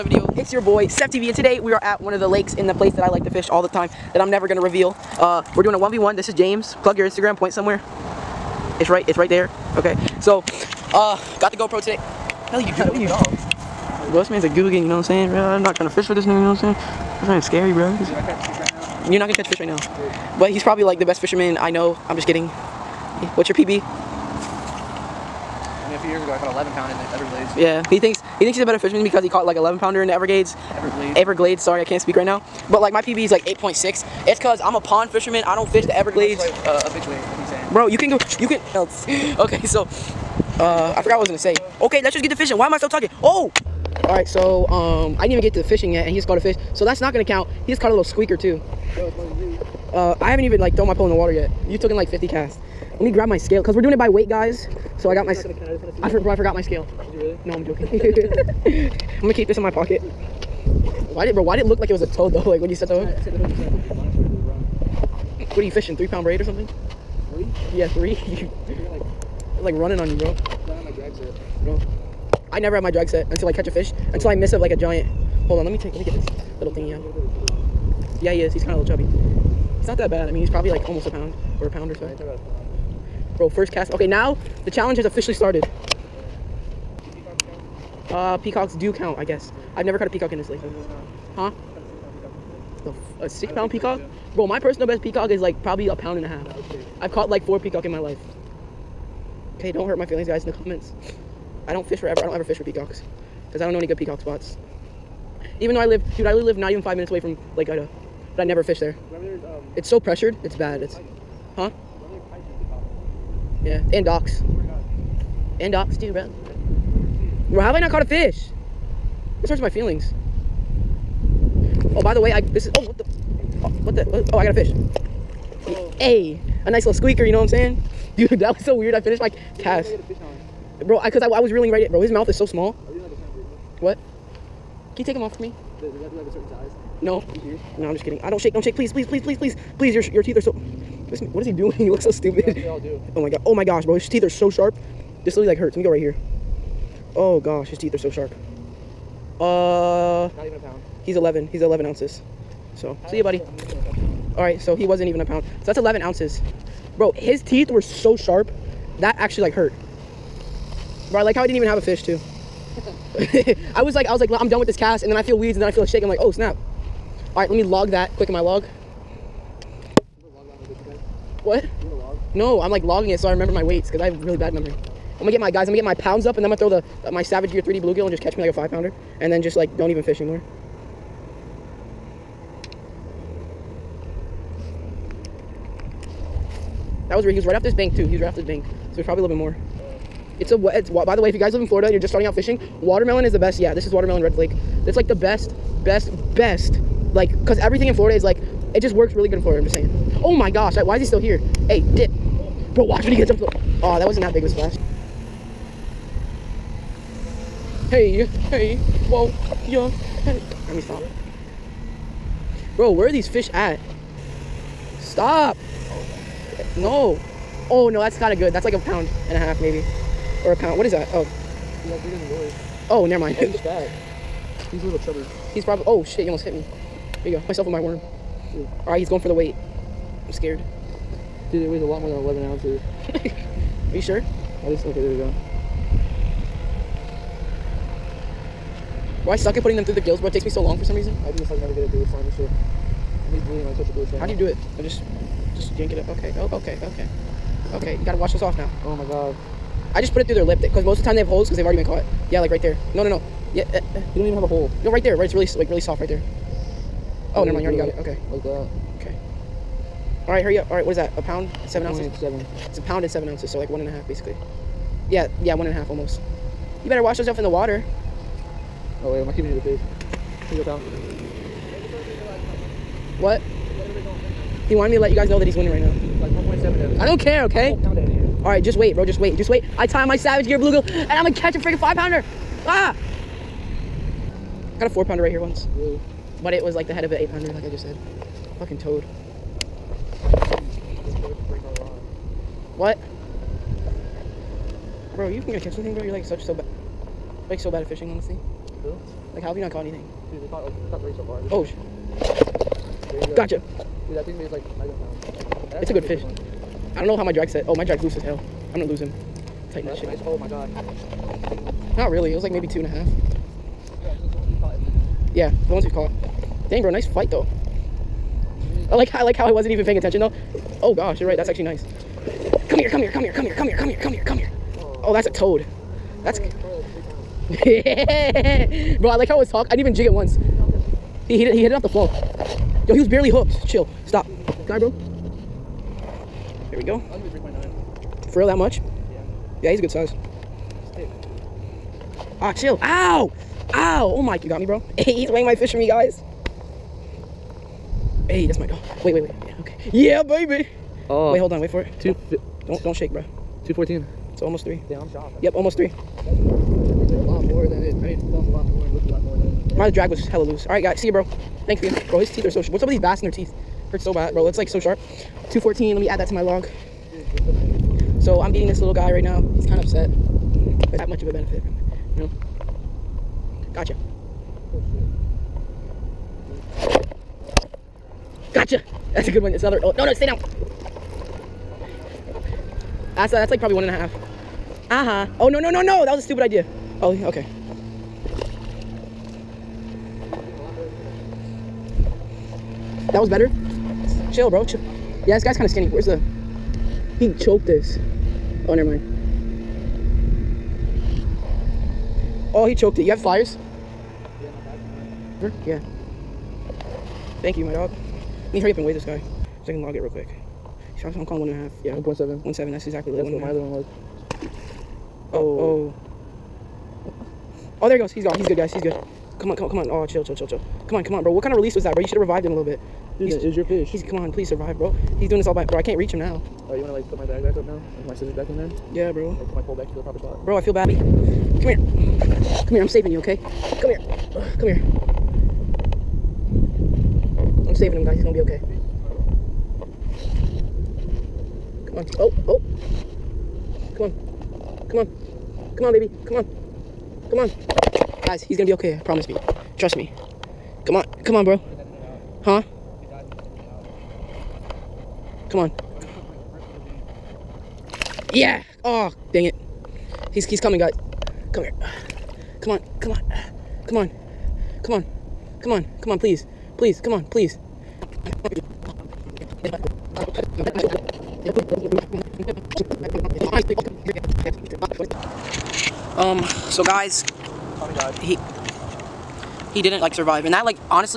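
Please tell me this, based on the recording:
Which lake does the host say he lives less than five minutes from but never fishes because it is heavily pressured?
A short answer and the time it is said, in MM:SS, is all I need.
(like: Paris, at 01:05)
Lake Ida, at 01:47.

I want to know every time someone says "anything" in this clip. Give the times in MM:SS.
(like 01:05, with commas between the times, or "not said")
04:55, 04:59.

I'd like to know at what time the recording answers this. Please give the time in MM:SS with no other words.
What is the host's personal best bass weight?
00:33.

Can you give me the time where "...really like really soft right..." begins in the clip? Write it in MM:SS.
04:15.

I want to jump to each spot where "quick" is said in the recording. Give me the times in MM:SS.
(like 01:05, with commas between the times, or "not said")
02:48, 06:50.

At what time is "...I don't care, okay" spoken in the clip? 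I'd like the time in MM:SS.
04:36.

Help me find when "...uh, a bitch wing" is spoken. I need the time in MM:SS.
00:36.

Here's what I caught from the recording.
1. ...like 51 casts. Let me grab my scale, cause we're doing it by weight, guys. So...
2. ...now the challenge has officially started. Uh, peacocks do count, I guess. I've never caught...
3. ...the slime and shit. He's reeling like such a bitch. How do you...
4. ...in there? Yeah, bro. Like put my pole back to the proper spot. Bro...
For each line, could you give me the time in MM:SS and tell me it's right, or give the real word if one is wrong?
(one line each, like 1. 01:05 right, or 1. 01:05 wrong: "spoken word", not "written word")
1. 00:51 wrong: "50", not "51"
2. 01:24 right
3. 04:02 wrong: "bleeding", not "reeling"
4. 07:08 right.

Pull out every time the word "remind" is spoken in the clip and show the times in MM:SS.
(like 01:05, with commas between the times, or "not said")
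not said.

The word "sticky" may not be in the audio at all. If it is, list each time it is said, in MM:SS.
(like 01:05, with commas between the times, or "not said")
not said.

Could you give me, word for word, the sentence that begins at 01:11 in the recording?
Bro, I never have my drag set until I catch a fish, until I miss a, like a giant.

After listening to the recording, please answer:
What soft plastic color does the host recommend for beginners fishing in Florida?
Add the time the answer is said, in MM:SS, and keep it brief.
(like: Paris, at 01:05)
watermelon red flake, at 03:13.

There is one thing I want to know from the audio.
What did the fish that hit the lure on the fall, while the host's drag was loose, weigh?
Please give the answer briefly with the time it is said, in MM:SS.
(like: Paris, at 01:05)
2 pounds 14 ounces, at 05:53.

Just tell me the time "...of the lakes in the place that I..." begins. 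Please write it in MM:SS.
00:02.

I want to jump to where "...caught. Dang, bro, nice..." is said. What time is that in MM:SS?
05:15.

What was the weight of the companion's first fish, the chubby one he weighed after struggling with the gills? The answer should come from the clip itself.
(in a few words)
1 pound 7 ounces.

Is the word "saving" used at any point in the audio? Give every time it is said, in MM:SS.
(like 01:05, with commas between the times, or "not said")
07:12, 07:17.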